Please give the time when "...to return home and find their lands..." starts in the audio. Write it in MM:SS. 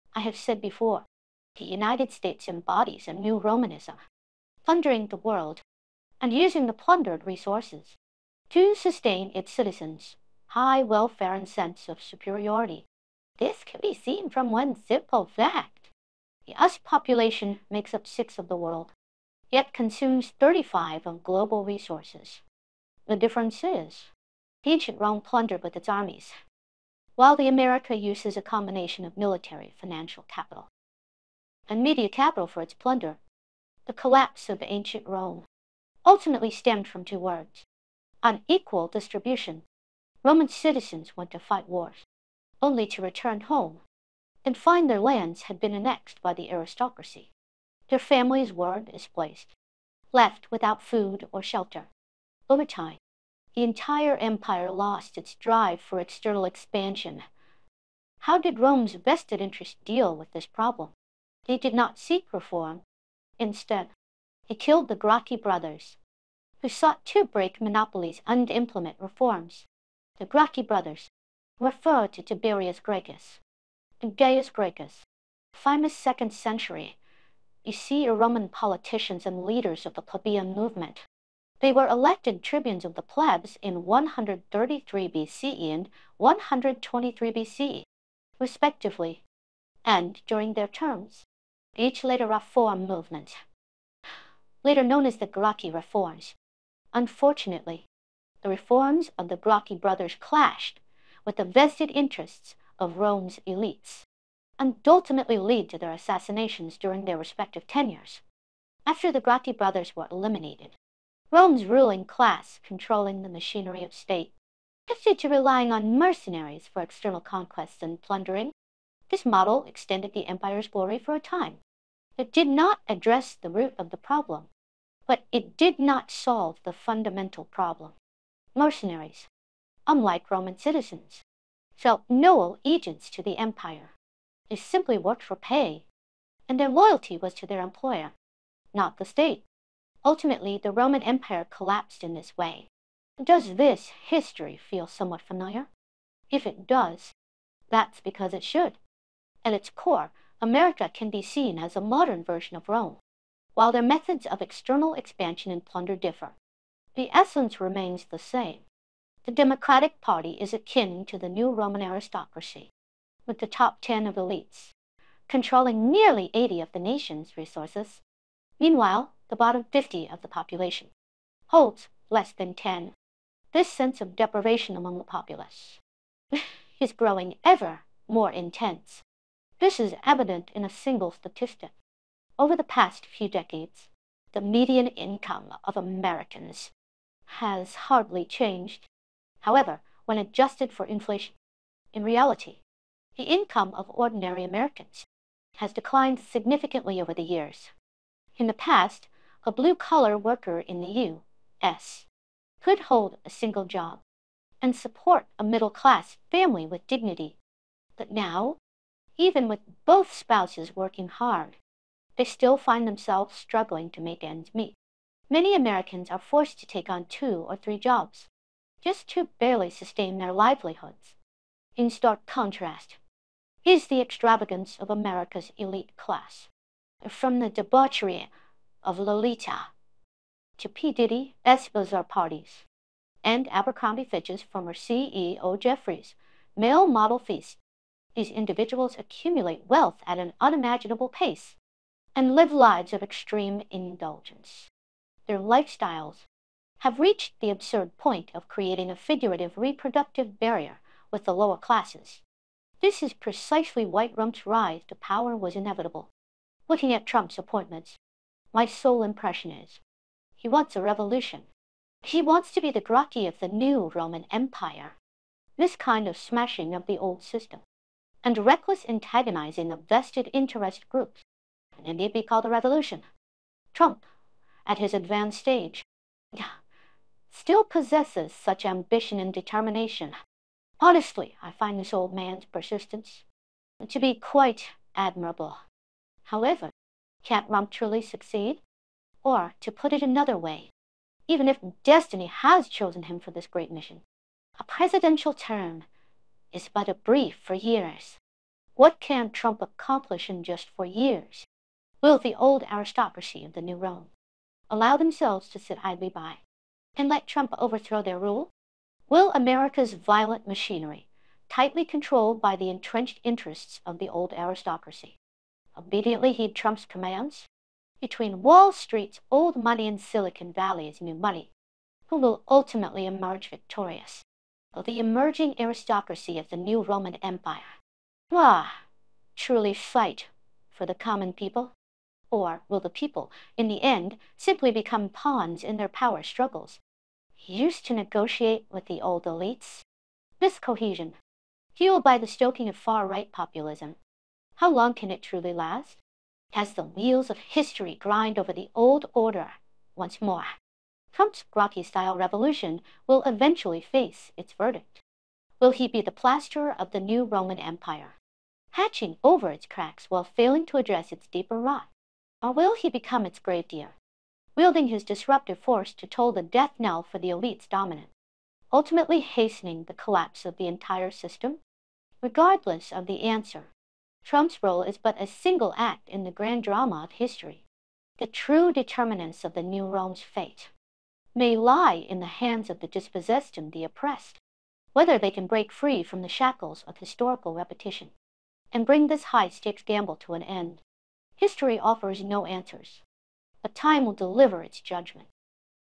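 00:42.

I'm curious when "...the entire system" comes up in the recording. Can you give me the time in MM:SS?
06:10.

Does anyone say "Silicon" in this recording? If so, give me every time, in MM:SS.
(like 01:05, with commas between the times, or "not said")
05:20.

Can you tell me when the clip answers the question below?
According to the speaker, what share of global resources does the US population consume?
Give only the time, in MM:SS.
00:20.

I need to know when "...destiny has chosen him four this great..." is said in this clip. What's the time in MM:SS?
04:51.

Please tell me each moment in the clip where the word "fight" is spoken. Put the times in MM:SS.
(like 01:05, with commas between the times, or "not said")
00:41, 05:29.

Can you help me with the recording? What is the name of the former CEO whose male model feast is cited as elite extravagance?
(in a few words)
Jeffries.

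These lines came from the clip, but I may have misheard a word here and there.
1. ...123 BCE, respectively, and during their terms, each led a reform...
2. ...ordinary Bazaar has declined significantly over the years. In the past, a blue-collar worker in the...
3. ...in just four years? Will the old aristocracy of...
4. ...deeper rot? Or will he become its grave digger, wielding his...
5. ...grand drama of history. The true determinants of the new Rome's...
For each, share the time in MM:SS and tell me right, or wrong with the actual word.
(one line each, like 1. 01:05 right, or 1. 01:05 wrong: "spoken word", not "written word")
1. 01:26 right
2. 03:13 wrong: "Americans", not "Bazaar"
3. 05:00 right
4. 06:01 right
5. 06:16 right.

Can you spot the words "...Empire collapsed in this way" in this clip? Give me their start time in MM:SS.
02:21.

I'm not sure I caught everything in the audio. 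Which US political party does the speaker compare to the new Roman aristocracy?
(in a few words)
Democratic Party.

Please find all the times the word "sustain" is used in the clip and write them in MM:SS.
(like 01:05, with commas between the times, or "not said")
00:08, 03:39.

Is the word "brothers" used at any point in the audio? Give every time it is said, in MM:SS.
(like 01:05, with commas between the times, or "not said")
01:05, 01:10, 01:39, 01:49.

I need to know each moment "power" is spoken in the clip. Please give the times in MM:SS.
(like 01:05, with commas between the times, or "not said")
04:14, 05:35.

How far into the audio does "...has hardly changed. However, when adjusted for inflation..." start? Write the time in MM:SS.
03:07.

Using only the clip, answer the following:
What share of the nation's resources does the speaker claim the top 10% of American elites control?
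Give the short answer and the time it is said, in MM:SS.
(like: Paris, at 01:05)
nearly 80%, at 02:45.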